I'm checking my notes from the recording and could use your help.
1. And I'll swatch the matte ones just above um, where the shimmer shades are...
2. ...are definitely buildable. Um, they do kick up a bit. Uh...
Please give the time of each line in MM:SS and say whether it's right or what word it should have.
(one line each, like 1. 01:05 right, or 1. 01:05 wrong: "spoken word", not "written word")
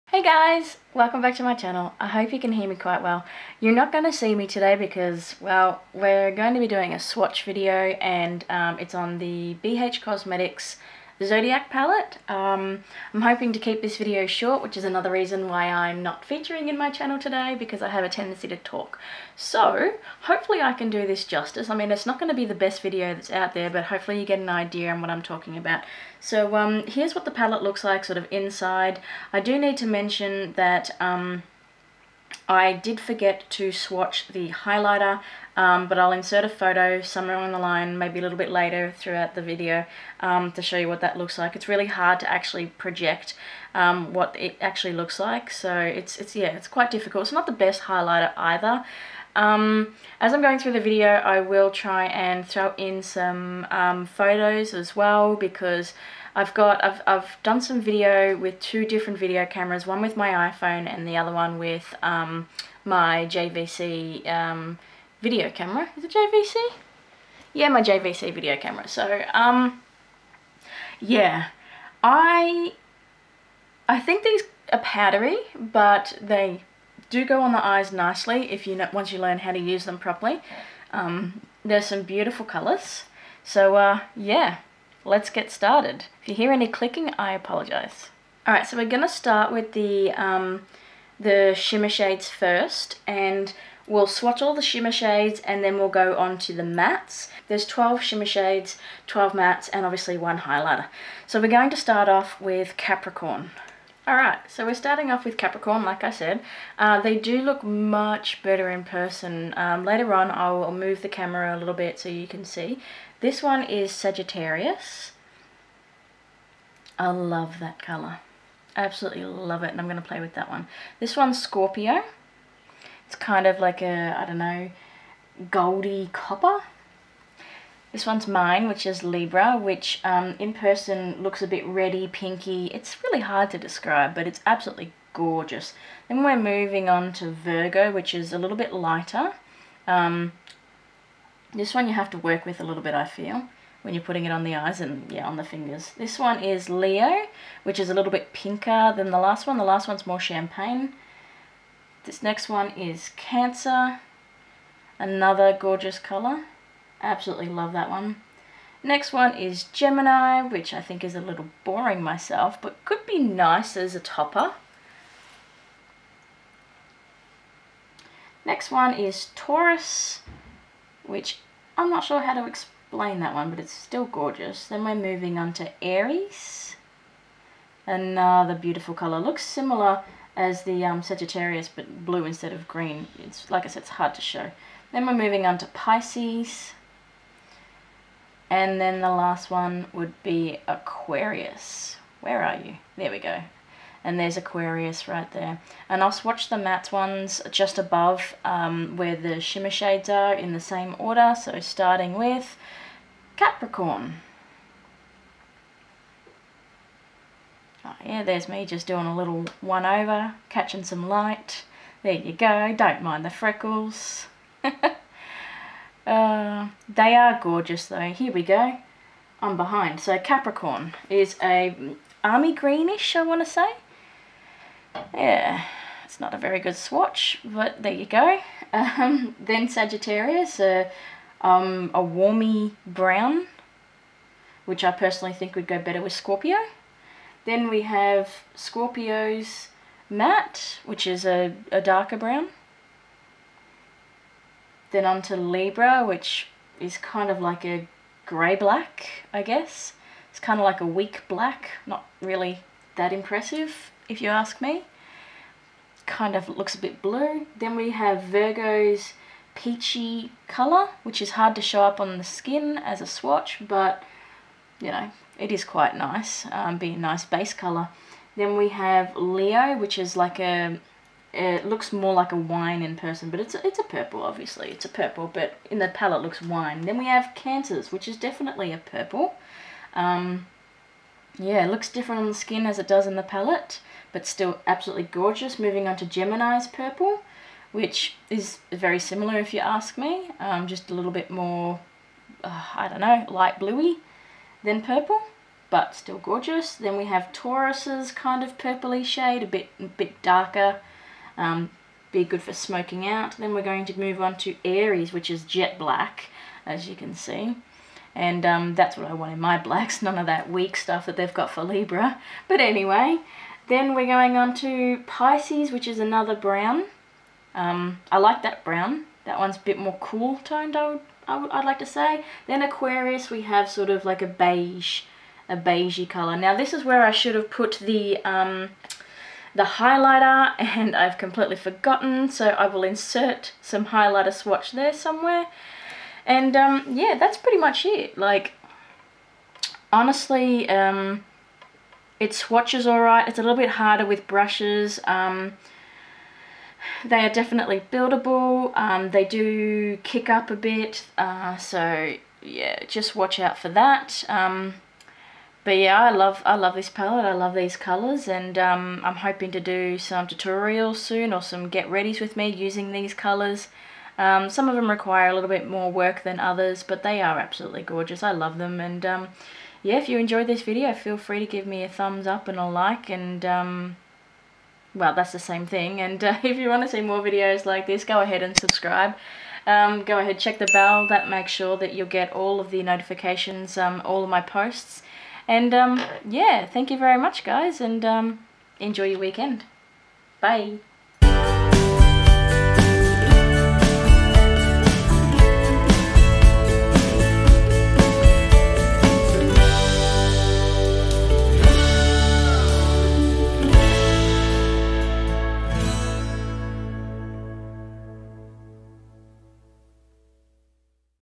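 1. 03:15 right
2. 05:47 right.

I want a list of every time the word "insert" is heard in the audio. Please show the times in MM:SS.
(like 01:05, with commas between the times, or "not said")
00:36, 05:32.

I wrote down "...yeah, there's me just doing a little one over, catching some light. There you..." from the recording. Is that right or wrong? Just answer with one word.
right.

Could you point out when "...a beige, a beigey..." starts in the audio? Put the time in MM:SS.
05:24.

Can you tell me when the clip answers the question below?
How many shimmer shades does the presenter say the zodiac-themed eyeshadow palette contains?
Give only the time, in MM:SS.
01:37.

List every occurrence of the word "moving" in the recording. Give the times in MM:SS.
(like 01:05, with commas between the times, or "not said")
02:16, 02:54, 03:05, 04:45.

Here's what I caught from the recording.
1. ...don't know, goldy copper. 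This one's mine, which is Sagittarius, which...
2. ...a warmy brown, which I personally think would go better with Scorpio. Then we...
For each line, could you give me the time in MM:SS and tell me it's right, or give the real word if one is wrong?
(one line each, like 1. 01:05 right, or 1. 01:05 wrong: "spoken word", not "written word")
1. 02:04 wrong: "Libra", not "Sagittarius"
2. 03:51 right.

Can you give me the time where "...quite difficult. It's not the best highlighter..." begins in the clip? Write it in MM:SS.
00:46.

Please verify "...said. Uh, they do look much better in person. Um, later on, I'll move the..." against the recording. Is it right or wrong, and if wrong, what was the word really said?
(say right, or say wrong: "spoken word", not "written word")
right.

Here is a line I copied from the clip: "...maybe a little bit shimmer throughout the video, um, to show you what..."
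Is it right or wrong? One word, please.
wrong.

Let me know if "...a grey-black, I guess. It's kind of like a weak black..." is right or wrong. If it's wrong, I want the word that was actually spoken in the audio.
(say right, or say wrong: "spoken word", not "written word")
right.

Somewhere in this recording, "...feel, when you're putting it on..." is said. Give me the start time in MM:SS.
02:23.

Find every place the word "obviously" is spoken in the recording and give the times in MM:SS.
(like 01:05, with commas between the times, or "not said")
01:39, 04:34.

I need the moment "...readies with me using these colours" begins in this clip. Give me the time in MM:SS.
06:01.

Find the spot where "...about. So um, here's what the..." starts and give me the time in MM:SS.
00:25.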